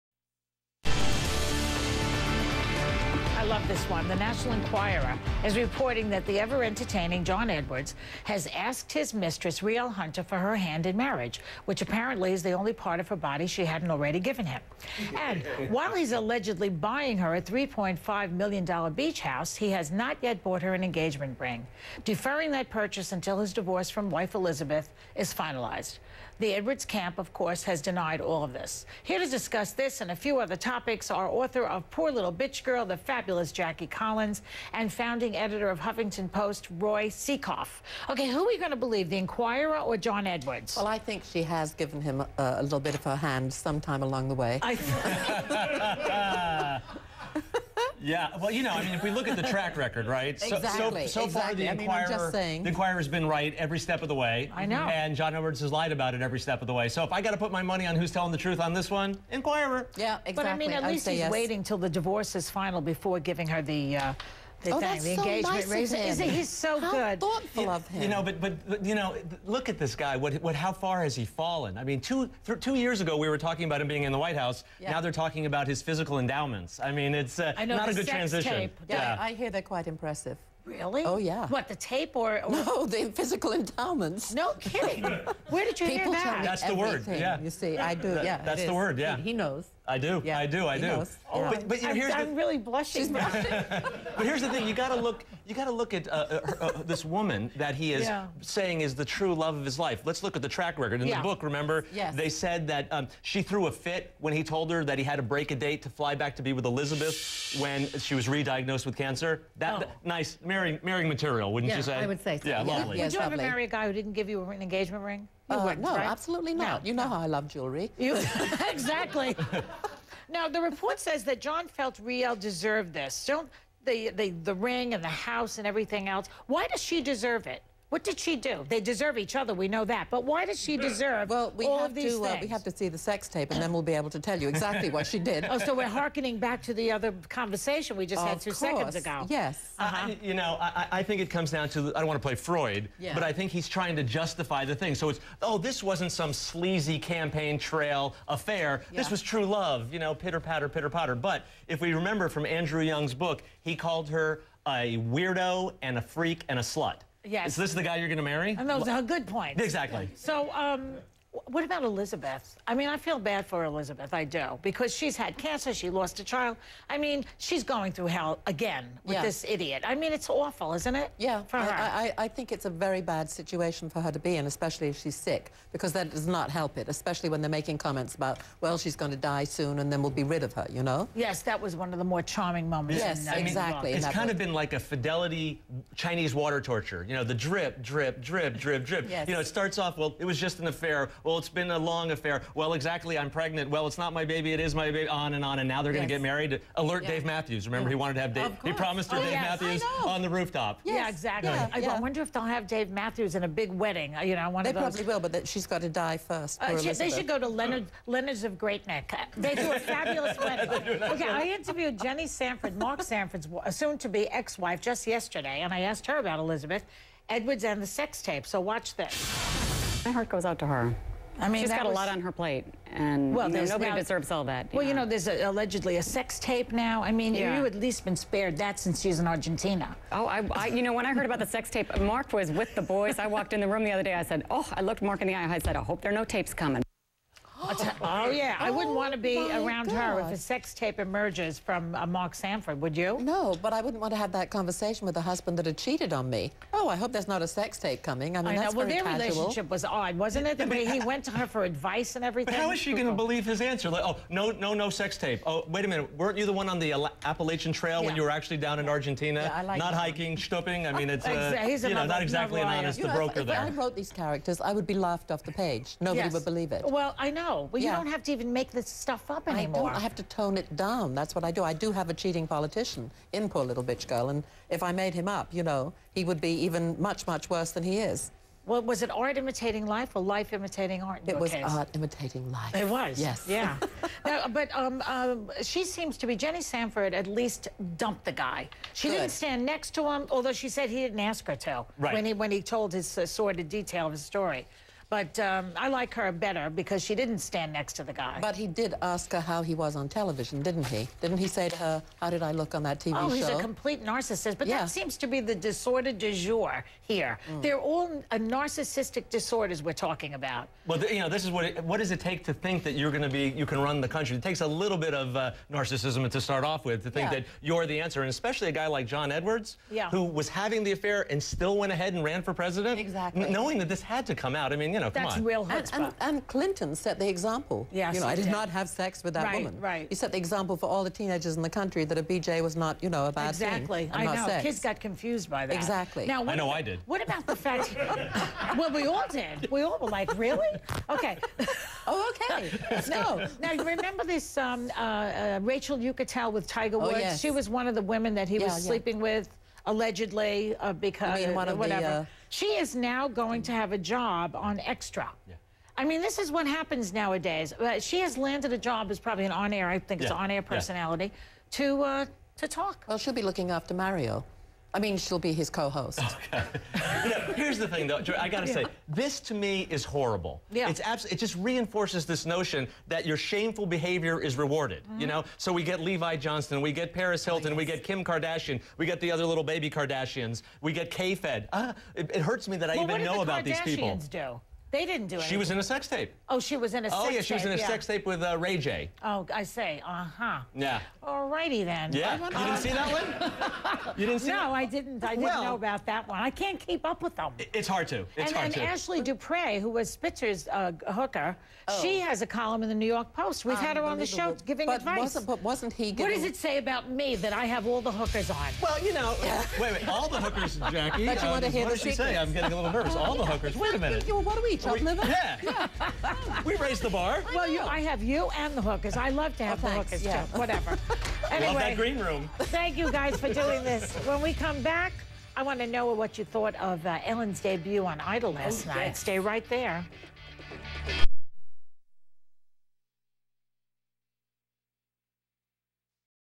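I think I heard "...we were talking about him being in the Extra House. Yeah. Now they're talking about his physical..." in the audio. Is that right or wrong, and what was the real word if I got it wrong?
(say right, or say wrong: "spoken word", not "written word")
wrong: "White", not "Extra".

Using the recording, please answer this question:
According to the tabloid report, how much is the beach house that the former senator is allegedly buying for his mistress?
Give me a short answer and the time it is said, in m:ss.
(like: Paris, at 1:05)
$3.5 million, at 0:17.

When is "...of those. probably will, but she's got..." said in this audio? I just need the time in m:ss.
3:24.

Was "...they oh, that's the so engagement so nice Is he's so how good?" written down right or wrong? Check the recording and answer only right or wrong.
right.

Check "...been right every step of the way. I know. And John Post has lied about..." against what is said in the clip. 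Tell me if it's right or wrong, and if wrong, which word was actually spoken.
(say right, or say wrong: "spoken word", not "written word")
wrong: "Edwards", not "Post".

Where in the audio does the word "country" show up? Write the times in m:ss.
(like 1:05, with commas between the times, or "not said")
5:14, 5:31.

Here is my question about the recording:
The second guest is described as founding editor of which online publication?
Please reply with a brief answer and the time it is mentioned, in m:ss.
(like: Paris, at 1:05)
Huffington Post, at 0:35.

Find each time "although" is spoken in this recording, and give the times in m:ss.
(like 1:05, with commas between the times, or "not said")
4:50.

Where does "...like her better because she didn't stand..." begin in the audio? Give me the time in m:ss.
4:55.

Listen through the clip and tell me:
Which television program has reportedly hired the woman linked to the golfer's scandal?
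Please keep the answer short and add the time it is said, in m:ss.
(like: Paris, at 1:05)
Extra, at 5:54.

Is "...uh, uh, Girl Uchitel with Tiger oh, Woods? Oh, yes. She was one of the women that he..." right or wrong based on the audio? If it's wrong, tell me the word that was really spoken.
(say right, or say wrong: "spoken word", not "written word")
wrong: "Rachel", not "Girl".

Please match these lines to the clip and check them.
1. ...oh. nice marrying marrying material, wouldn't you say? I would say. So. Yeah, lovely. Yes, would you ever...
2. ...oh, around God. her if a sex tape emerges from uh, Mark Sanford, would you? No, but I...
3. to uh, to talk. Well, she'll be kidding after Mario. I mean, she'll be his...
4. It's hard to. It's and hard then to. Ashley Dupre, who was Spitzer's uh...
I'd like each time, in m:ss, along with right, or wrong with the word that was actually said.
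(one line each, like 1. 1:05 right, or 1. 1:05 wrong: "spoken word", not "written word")
1. 1:49 right
2. 3:59 right
3. 6:01 wrong: "looking", not "kidding"
4. 6:37 right.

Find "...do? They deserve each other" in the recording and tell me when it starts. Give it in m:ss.
2:08.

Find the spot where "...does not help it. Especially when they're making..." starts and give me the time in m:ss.
2:56.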